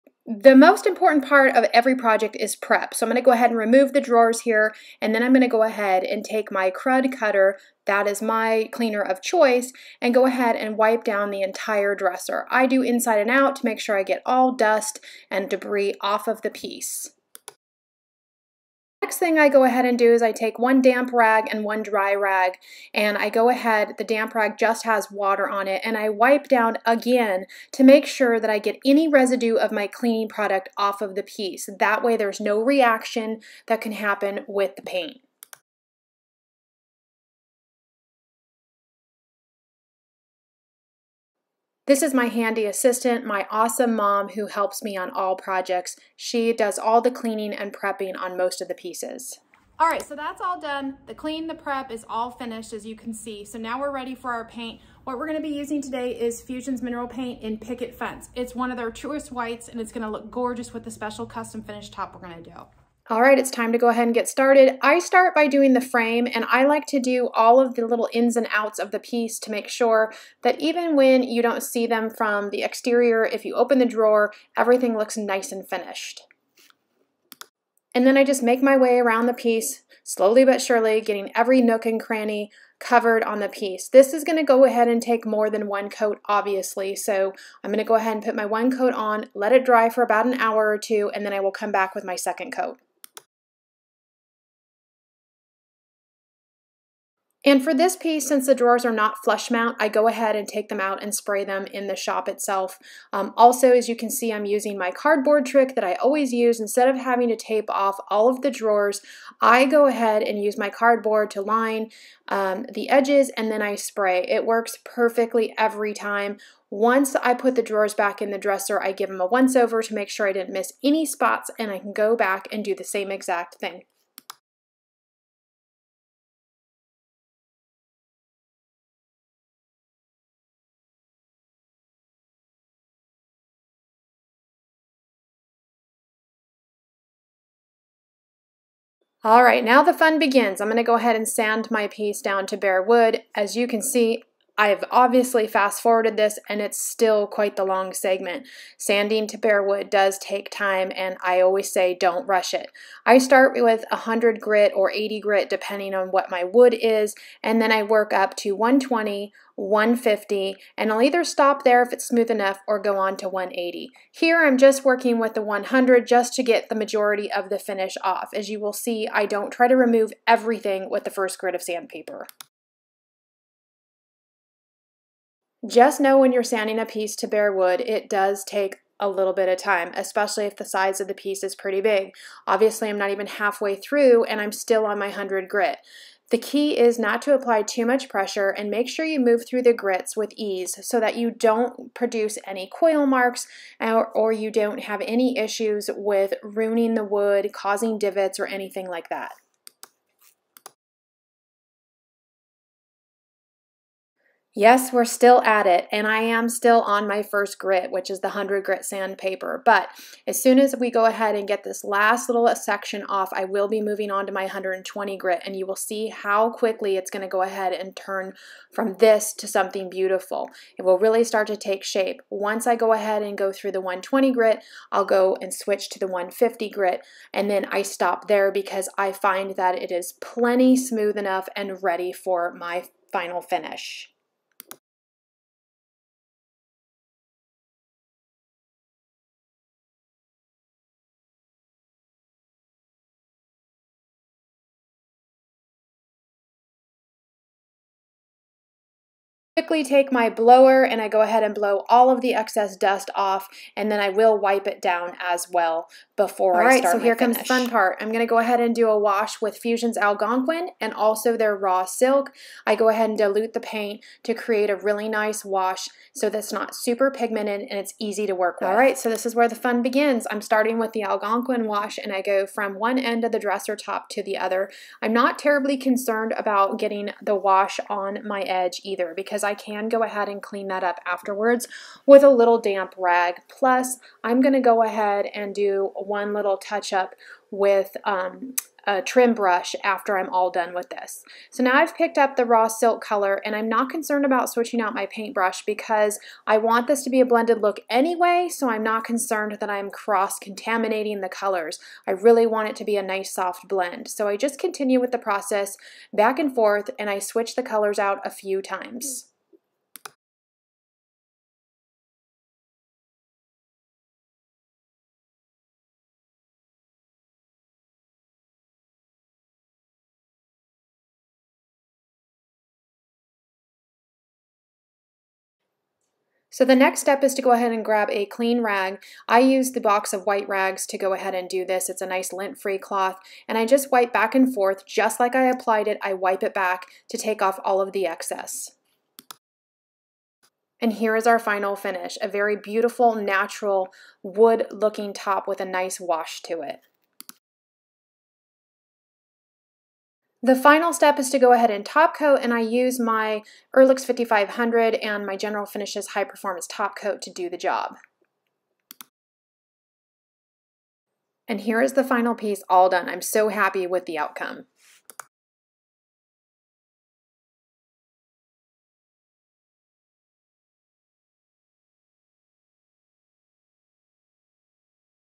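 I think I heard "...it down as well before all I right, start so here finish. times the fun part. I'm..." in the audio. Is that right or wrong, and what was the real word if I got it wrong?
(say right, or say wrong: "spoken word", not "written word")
wrong: "comes", not "times".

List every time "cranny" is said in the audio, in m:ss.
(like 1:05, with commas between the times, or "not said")
1:21.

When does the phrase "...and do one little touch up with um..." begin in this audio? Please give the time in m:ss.
4:45.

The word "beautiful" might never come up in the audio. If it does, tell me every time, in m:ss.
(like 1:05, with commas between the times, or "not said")
3:39, 5:42.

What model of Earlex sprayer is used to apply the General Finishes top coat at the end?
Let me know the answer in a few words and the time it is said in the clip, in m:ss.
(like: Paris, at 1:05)
Earlex 5500, at 5:53.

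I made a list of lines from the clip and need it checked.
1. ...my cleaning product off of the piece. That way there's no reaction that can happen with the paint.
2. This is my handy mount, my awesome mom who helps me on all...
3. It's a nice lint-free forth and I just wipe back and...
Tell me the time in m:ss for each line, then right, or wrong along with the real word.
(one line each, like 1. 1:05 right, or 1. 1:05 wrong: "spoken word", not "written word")
1. 0:29 right
2. 0:41 wrong: "assistant", not "mount"
3. 5:31 wrong: "cloth", not "forth".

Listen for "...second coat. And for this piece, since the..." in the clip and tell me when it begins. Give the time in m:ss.
1:32.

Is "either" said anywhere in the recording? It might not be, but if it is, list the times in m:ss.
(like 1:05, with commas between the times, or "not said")
2:41, 4:38.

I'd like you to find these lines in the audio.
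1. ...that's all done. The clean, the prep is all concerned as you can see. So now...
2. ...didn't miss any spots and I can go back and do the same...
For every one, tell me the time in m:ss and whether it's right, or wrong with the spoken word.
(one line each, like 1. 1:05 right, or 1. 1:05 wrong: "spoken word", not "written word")
1. 0:50 wrong: "finished", not "concerned"
2. 2:00 right.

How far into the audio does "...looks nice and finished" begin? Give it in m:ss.
1:14.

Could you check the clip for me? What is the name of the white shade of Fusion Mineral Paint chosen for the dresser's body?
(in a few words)
Picket Fence.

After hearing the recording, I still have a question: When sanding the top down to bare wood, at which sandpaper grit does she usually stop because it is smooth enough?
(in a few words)
150.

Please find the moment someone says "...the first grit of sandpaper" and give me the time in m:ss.
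2:51.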